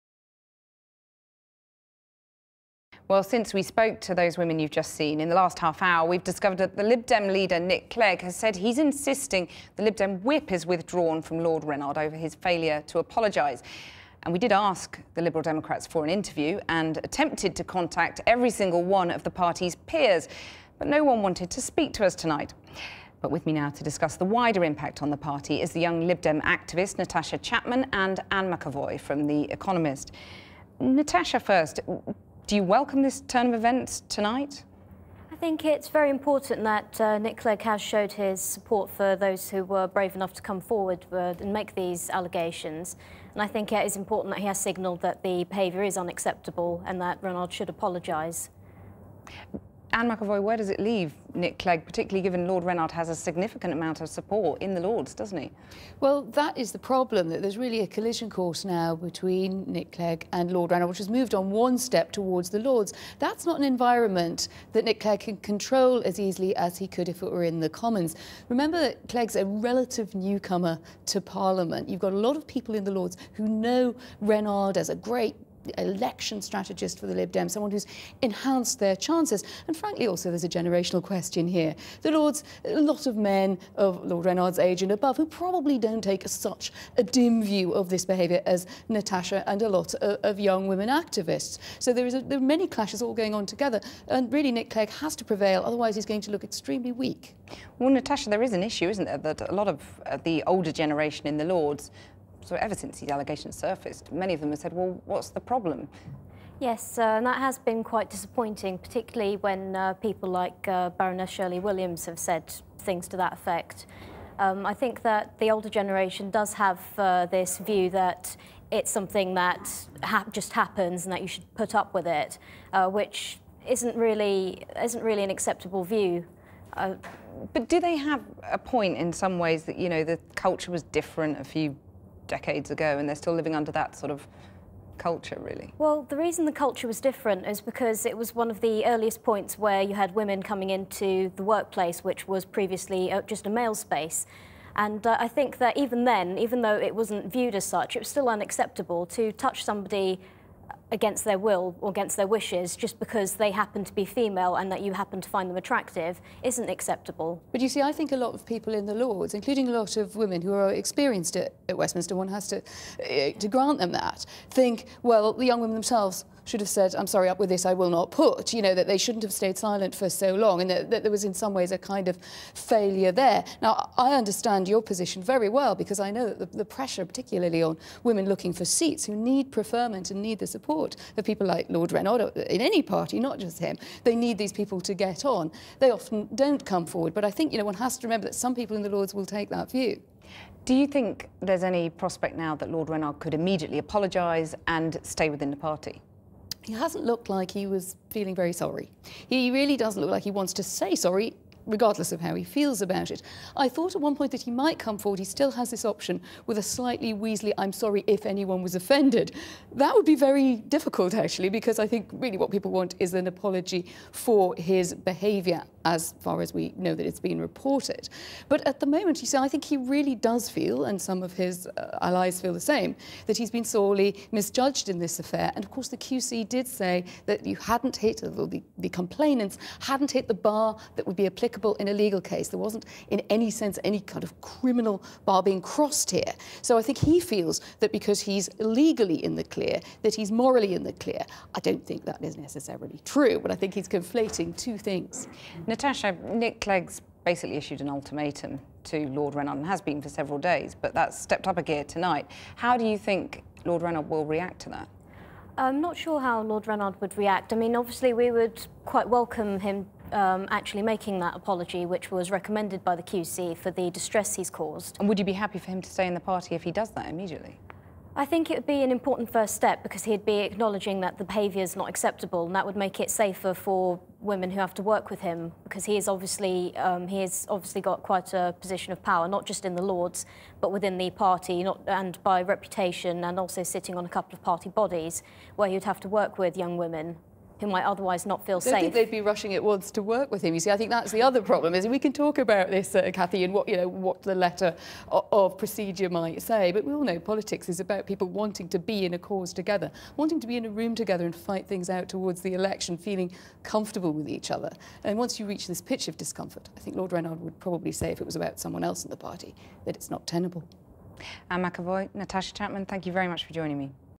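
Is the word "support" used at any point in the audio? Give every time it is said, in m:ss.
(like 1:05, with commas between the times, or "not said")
0:38, 0:54, 3:00.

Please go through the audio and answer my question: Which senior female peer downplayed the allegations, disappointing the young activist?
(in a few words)
Shirley Williams.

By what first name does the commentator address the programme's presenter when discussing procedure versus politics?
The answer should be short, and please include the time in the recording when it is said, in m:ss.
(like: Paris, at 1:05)
Cathy, at 4:53.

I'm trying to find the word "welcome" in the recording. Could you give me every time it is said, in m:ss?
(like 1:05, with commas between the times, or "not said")
0:32, 4:19.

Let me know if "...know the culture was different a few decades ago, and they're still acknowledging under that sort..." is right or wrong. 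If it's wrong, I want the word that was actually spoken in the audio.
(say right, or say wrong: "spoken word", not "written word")
wrong: "living", not "acknowledging".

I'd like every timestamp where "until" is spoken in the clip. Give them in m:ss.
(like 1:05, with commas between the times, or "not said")
not said.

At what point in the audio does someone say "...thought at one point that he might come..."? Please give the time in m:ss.
3:23.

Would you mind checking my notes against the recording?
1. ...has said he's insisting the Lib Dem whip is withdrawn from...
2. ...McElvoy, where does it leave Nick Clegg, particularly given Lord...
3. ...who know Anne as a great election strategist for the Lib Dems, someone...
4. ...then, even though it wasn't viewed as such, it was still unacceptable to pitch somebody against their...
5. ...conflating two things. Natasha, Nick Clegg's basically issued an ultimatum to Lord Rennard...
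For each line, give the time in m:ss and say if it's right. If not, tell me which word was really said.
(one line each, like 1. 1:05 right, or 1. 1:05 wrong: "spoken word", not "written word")
1. 0:08 right
2. 0:50 right
3. 1:13 wrong: "Rennard", not "Anne"
4. 2:26 wrong: "touch", not "pitch"
5. 4:03 right.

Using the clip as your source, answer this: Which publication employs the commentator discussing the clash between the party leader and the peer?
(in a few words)
The Economist.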